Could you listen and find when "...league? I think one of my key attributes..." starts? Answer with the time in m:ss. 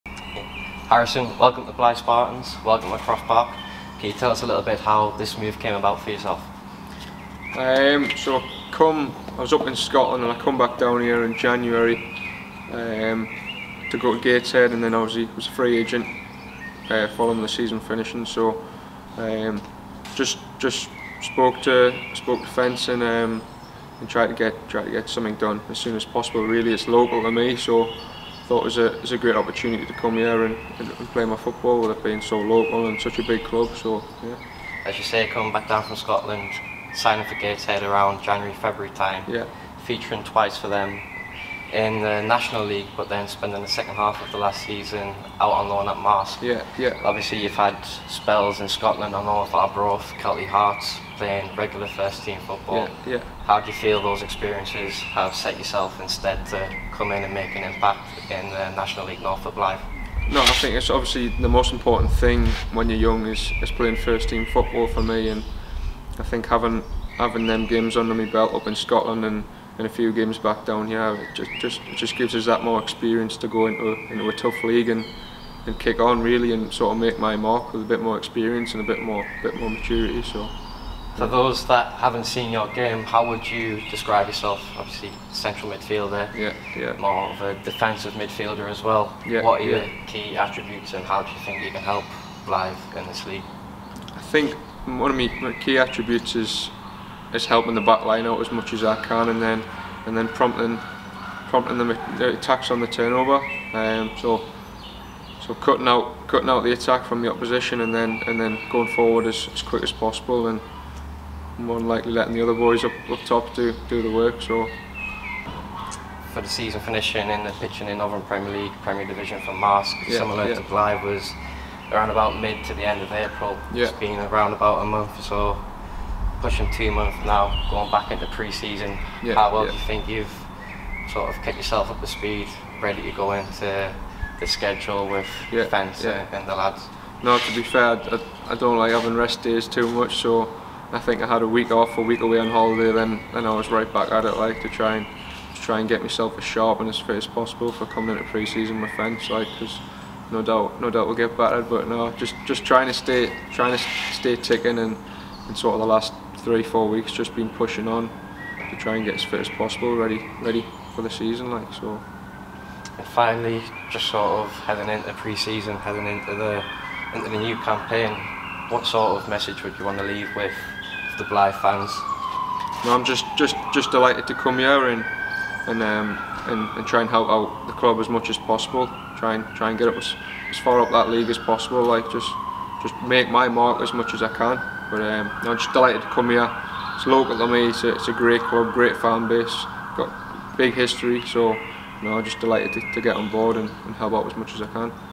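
1:33.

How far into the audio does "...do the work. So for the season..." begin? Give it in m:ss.
1:53.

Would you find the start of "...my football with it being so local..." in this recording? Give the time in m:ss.
0:31.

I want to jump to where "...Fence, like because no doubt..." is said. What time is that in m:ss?
2:28.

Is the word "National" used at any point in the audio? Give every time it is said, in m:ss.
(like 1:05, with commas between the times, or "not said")
0:42, 0:58.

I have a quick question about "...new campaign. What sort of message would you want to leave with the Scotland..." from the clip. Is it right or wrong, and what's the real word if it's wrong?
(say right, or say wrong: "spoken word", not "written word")
wrong: "Blyth", not "Scotland".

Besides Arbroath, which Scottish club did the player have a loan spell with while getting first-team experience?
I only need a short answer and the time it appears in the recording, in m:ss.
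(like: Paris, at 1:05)
Kelty Hearts, at 0:50.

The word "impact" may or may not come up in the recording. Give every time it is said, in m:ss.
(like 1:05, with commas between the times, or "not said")
0:57.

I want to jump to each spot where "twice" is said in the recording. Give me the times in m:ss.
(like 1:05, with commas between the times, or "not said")
0:40.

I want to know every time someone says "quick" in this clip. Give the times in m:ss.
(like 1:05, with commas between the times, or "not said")
1:49.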